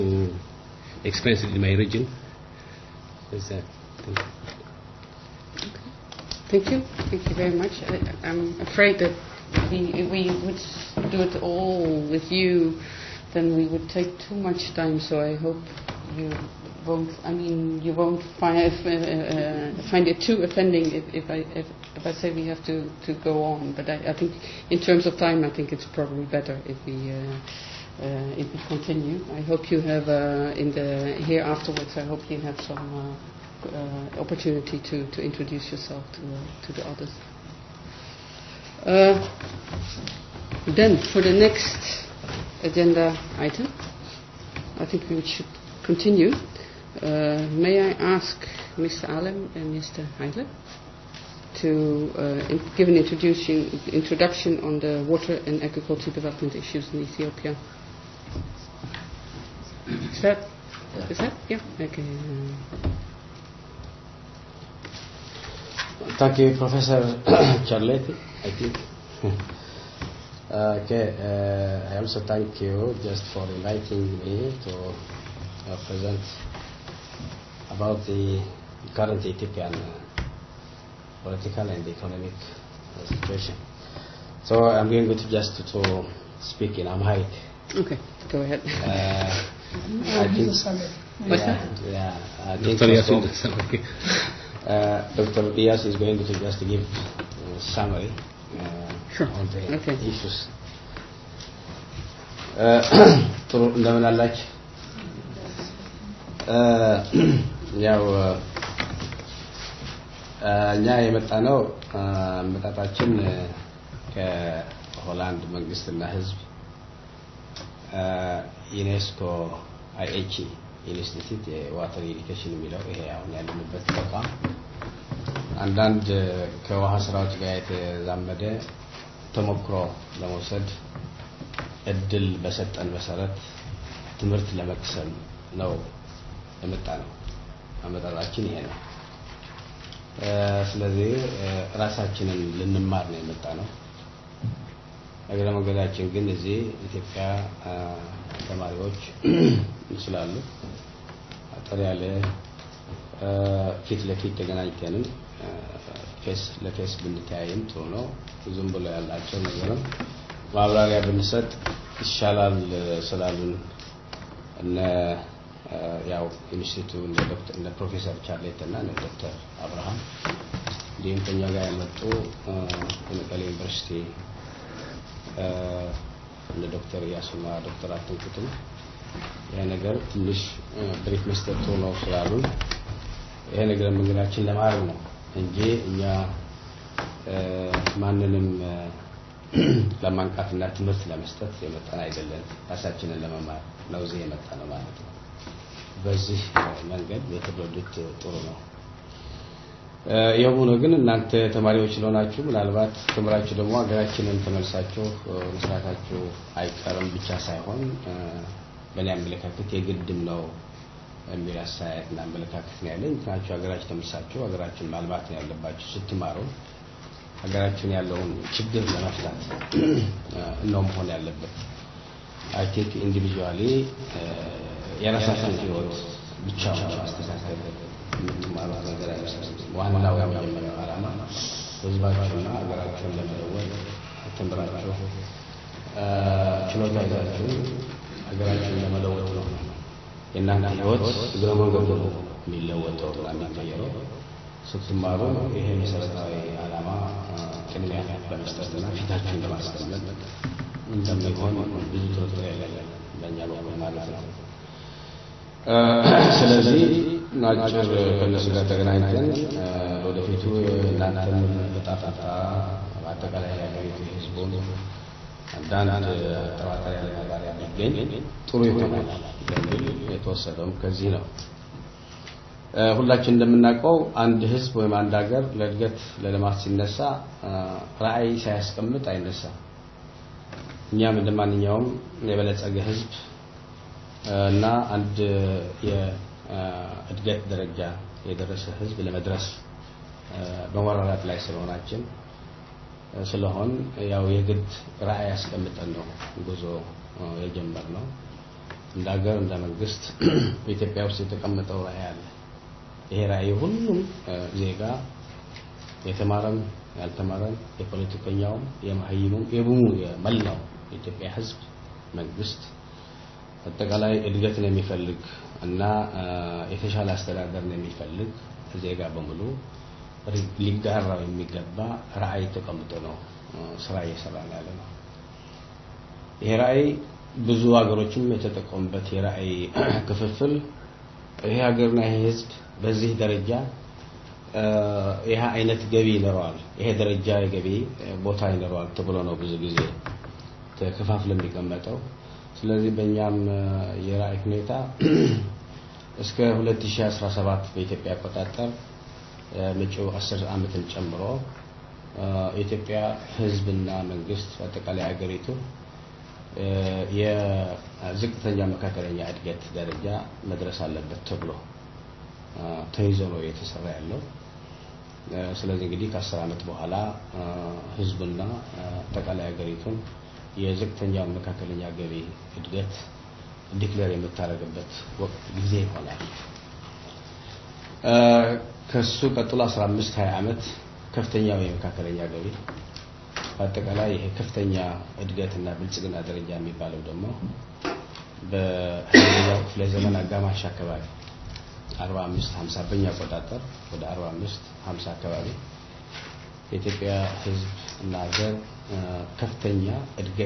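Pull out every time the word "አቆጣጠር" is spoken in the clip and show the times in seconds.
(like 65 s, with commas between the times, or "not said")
348 s, 393 s.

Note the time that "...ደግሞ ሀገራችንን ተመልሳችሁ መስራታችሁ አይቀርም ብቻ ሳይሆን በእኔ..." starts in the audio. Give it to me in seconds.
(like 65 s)
203 s.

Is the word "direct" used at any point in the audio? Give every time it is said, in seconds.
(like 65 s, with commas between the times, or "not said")
not said.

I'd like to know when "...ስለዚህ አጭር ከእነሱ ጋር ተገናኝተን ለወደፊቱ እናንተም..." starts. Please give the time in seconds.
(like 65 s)
256 s.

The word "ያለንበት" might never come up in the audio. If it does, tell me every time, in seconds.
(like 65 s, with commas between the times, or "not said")
123 s.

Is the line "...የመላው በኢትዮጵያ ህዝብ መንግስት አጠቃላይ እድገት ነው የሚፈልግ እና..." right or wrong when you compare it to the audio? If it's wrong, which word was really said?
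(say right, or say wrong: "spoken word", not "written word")
wrong: "የኢትዮጵያ", not "በኢትዮጵያ".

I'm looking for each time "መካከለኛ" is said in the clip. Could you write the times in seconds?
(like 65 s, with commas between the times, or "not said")
358 s, 371 s, 381 s.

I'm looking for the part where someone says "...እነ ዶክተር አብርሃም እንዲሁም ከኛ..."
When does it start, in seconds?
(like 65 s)
168 s.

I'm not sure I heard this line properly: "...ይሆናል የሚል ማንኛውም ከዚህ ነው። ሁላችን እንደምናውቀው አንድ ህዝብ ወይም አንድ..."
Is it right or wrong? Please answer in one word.
wrong.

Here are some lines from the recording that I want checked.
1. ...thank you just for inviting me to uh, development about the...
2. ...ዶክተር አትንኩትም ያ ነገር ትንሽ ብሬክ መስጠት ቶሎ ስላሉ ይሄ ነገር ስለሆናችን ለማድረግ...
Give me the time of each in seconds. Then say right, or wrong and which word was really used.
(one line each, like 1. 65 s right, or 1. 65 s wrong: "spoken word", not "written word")
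1. 72 s wrong: "present", not "development"
2. 177 s wrong: "መንገዳችን", not "ስለሆናችን".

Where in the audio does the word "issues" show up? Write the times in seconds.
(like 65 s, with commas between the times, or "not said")
56 s, 100 s.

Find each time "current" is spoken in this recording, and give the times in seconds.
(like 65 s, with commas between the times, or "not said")
78 s.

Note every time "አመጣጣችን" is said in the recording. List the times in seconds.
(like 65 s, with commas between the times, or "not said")
112 s, 137 s.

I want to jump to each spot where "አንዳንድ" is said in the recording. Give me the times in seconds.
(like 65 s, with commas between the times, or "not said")
125 s, 265 s.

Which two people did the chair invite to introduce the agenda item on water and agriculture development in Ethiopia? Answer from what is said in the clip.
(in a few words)
Mr. Alem and Mr. Heidler.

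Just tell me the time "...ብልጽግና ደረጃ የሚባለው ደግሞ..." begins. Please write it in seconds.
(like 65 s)
385 s.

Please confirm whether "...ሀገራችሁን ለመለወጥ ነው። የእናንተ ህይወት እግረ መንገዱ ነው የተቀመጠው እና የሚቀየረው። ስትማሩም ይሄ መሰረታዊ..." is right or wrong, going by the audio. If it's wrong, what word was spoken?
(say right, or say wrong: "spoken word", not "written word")
wrong: "የሚለወጠው", not "የተቀመጠው".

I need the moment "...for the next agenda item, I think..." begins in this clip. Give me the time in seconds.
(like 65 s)
41 s.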